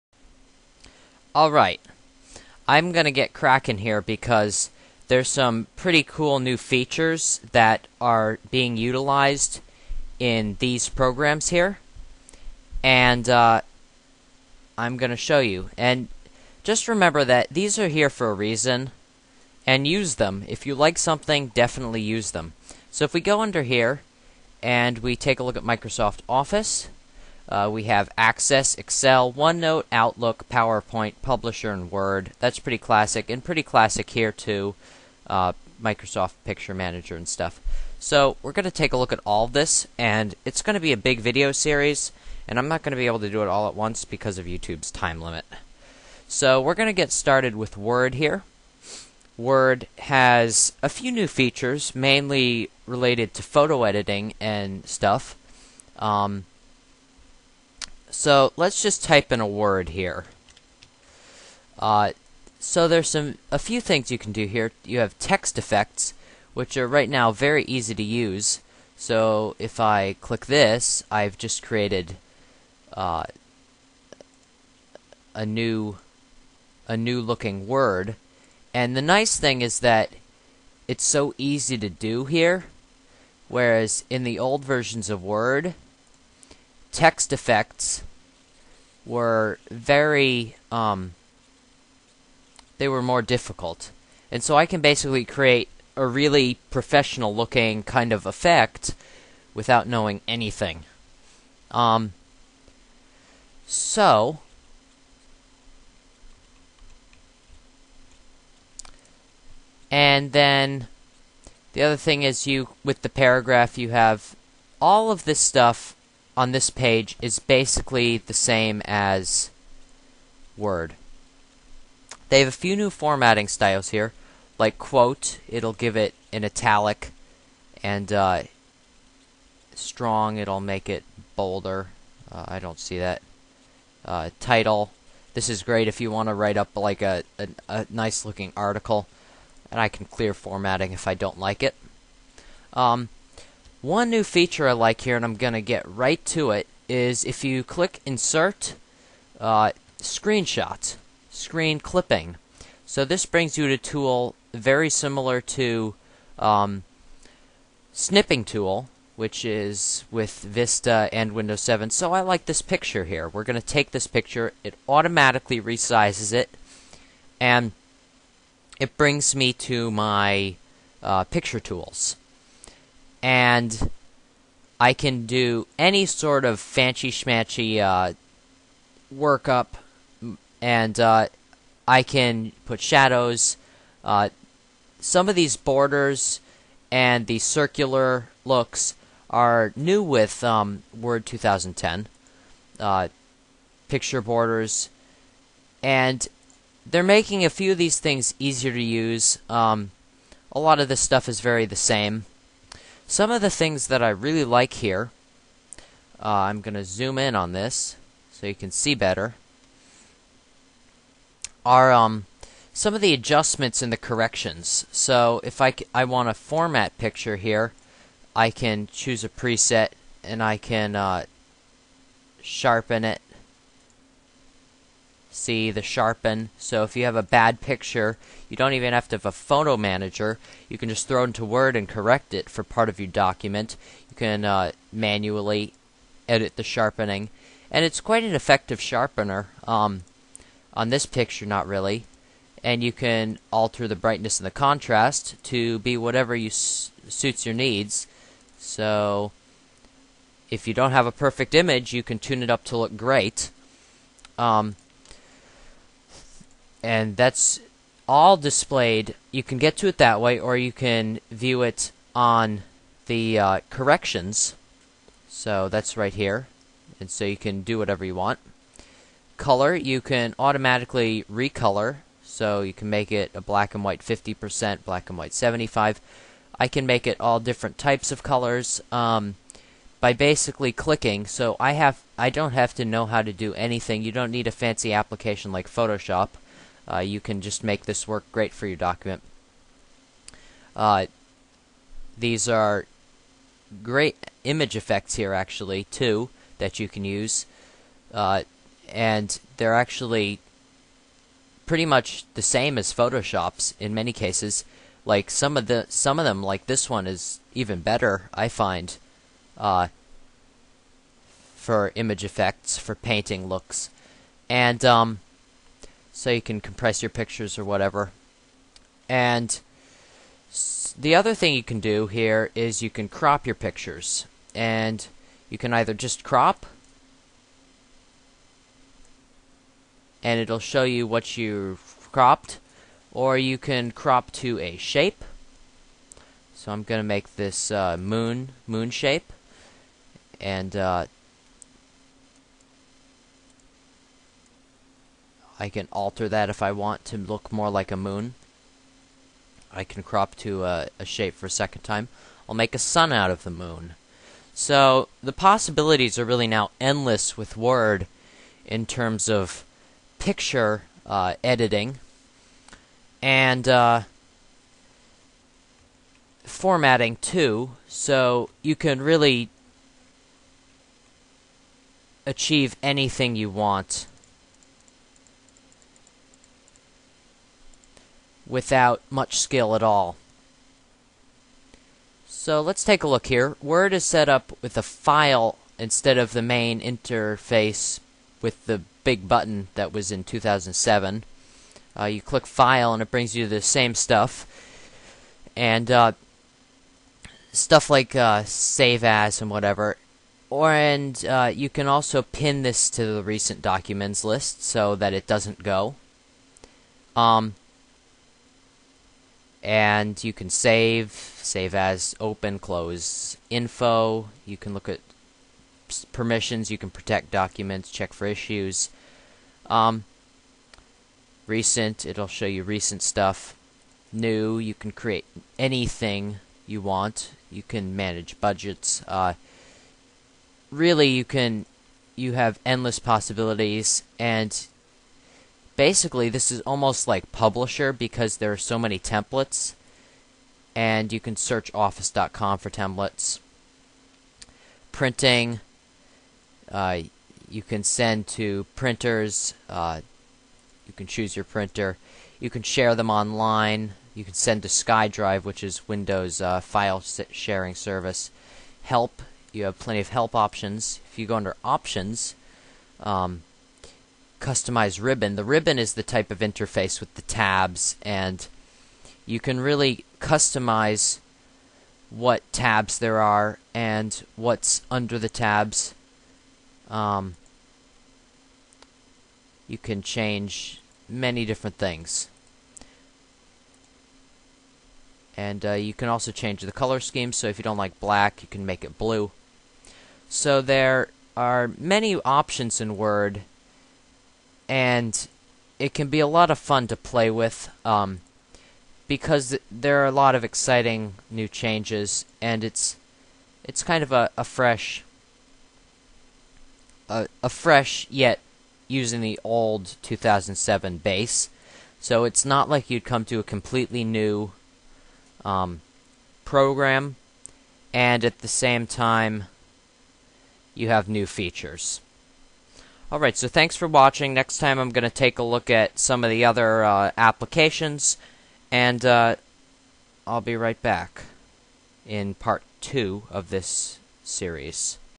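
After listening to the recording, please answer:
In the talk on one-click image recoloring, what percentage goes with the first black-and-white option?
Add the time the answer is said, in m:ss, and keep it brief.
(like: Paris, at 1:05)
50%, at 4:34.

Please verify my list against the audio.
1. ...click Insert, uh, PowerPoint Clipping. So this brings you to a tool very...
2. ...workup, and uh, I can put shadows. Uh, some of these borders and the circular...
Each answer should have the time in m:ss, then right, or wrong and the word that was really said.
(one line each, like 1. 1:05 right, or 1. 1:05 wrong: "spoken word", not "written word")
1. 2:27 wrong: "Screen", not "PowerPoint"
2. 2:59 right.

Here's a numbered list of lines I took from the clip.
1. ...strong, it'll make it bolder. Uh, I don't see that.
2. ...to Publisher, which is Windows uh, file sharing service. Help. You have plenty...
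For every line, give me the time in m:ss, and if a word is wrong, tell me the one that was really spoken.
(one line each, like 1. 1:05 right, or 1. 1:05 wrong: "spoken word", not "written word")
1. 2:09 right
2. 7:34 wrong: "SkyDrive", not "Publisher".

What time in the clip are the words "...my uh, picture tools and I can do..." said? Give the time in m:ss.
2:49.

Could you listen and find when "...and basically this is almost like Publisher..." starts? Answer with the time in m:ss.
7:14.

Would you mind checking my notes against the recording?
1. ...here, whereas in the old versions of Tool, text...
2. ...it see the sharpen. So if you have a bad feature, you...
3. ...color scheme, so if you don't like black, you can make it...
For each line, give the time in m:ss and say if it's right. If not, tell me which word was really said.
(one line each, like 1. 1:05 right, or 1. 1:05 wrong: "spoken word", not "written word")
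1. 1:22 wrong: "Word", not "Tool"
2. 3:43 wrong: "picture", not "feature"
3. 8:06 right.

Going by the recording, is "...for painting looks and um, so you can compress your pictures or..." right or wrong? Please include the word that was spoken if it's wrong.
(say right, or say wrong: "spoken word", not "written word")
right.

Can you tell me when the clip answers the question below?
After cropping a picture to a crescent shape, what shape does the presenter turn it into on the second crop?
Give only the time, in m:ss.
5:52.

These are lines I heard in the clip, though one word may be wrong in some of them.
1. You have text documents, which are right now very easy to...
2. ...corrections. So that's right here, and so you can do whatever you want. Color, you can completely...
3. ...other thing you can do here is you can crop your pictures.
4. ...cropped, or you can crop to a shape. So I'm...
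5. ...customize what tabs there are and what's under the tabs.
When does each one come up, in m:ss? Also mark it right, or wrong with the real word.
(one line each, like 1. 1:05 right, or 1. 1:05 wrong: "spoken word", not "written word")
1. 1:04 wrong: "effects", not "documents"
2. 4:23 wrong: "automatically", not "completely"
3. 5:21 right
4. 5:32 right
5. 7:50 right.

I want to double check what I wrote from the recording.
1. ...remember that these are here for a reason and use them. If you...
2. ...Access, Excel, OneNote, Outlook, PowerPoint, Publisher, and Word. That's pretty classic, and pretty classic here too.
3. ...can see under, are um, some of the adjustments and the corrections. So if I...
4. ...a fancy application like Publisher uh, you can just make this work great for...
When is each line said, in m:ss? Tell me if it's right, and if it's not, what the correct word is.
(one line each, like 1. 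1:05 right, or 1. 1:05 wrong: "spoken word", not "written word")
1. 0:16 right
2. 0:28 right
3. 3:28 wrong: "better", not "under"
4. 4:44 wrong: "Photoshop", not "Publisher".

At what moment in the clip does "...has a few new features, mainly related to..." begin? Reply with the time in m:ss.
0:49.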